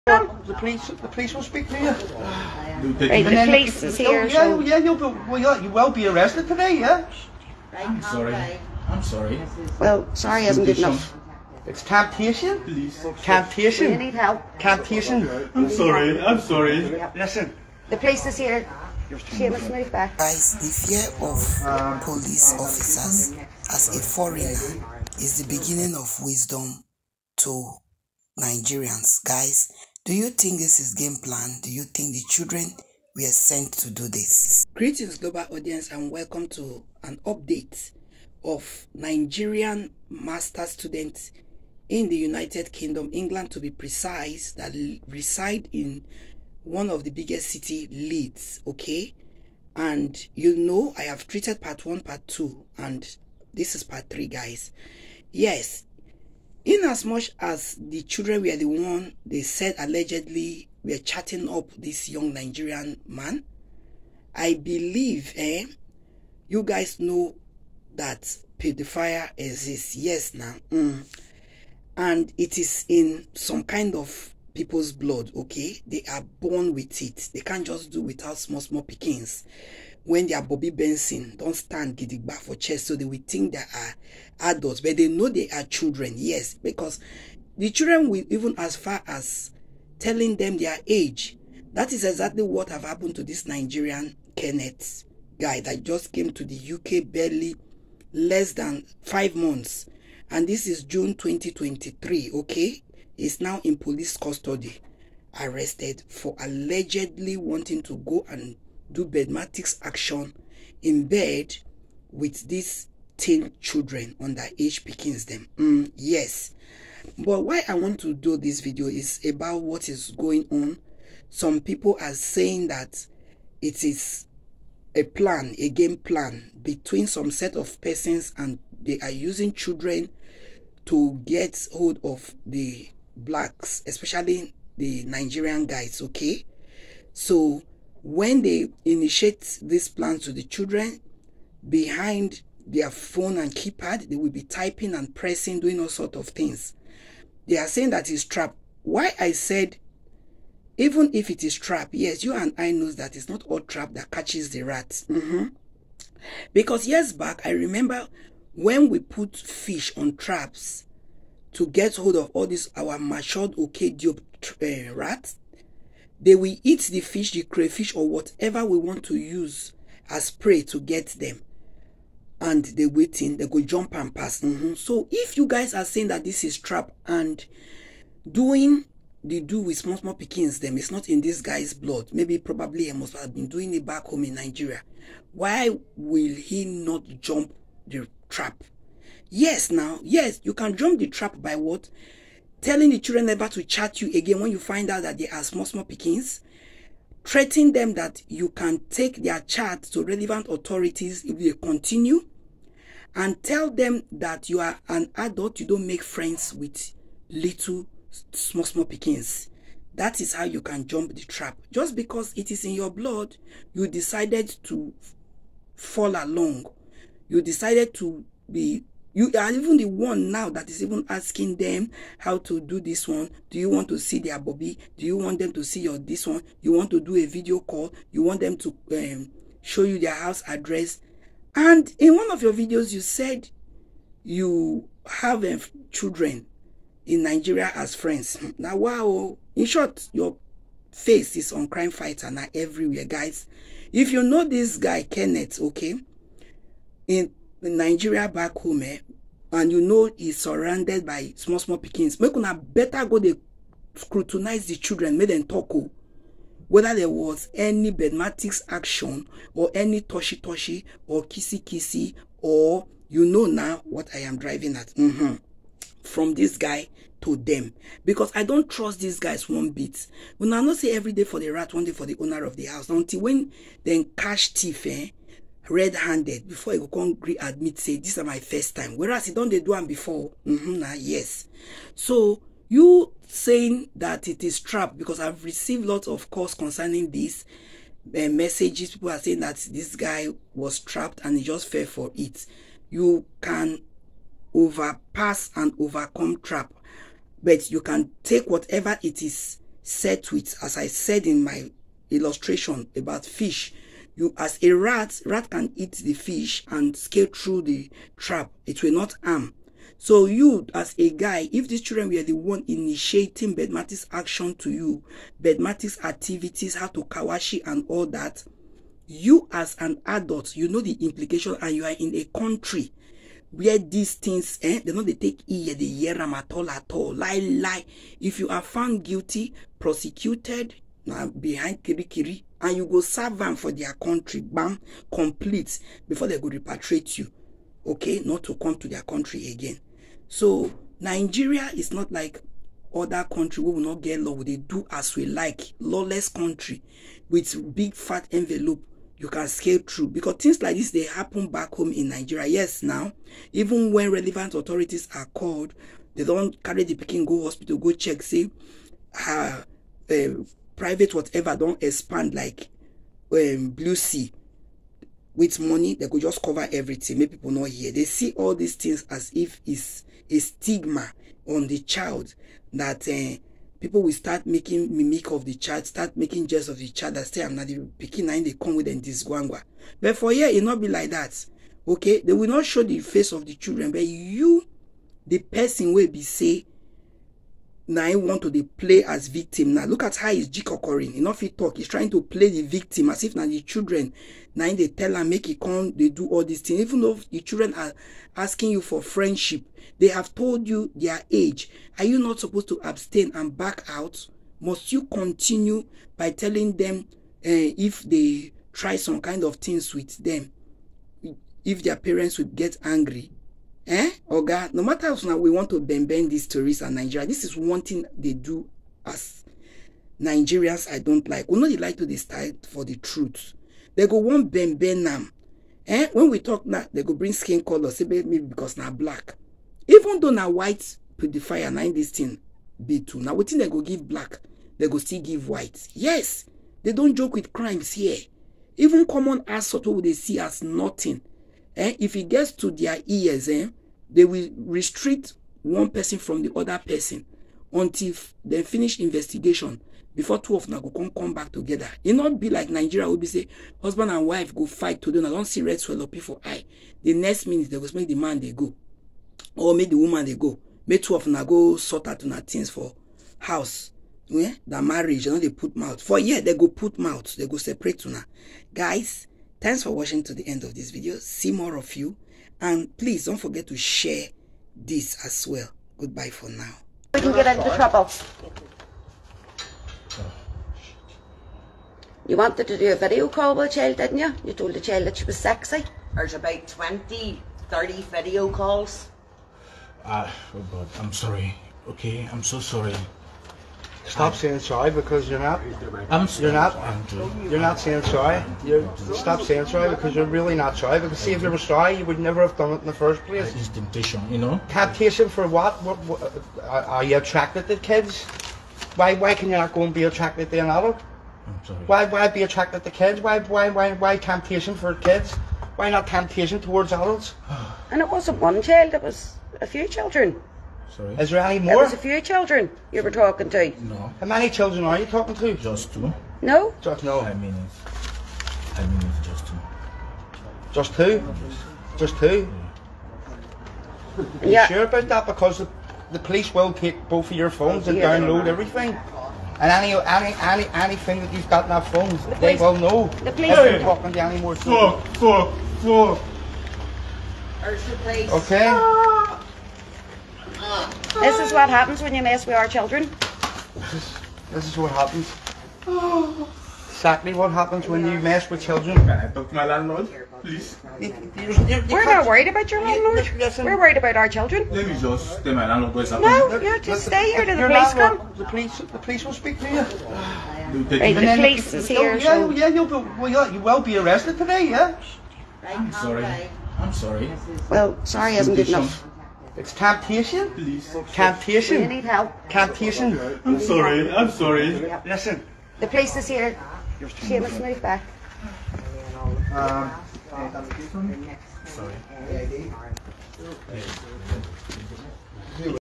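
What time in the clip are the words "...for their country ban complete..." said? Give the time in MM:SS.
05:33.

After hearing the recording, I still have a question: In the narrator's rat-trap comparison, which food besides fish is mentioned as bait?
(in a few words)
crayfish.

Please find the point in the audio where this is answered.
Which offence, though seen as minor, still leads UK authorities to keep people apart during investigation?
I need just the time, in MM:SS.
07:19.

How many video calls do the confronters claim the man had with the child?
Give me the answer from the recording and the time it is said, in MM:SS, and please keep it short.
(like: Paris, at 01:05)
20 to 30, at 08:06.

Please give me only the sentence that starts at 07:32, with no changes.
It e not be like Nigeria will be say husband and wife go fight today.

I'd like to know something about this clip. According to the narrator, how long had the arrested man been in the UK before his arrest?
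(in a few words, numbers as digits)
less than five months.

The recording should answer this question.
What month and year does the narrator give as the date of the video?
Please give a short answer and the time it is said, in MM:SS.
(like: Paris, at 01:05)
June 2023, at 01:40.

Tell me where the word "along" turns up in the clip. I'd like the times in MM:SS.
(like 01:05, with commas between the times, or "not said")
03:36.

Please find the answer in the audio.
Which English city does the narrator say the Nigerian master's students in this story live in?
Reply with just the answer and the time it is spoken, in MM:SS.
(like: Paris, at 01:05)
Leeds, at 00:47.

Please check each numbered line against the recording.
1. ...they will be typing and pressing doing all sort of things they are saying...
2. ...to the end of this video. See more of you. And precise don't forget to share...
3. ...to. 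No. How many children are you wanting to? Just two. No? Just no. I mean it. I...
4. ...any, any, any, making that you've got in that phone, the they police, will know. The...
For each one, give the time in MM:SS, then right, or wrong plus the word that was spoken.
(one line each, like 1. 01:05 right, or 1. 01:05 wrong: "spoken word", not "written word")
1. 02:24 right
2. 07:50 wrong: "please", not "precise"
3. 08:43 wrong: "talking", not "wanting"
4. 08:59 wrong: "anything", not "making".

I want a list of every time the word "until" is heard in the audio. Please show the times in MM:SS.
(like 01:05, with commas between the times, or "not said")
04:32, 07:27.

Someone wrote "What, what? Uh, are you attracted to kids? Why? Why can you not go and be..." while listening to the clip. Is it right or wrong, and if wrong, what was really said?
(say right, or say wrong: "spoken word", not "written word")
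right.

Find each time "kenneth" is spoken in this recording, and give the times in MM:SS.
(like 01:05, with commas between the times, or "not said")
01:34, 04:05.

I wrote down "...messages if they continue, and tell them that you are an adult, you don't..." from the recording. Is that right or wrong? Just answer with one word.
wrong.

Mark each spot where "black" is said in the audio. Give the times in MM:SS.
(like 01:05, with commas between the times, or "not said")
02:13, 07:08, 07:14.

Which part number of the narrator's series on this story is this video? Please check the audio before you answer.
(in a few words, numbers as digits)
part 3.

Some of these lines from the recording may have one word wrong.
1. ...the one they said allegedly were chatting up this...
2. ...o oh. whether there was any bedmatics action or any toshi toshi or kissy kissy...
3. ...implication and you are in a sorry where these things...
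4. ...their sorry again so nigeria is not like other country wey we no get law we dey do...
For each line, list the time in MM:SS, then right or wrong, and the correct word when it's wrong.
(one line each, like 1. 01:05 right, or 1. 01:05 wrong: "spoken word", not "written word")
1. 00:58 right
2. 04:15 right
3. 05:21 wrong: "country", not "sorry"
4. 05:38 wrong: "country", not "sorry".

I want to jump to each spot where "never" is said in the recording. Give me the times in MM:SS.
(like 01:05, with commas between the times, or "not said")
03:13, 08:22.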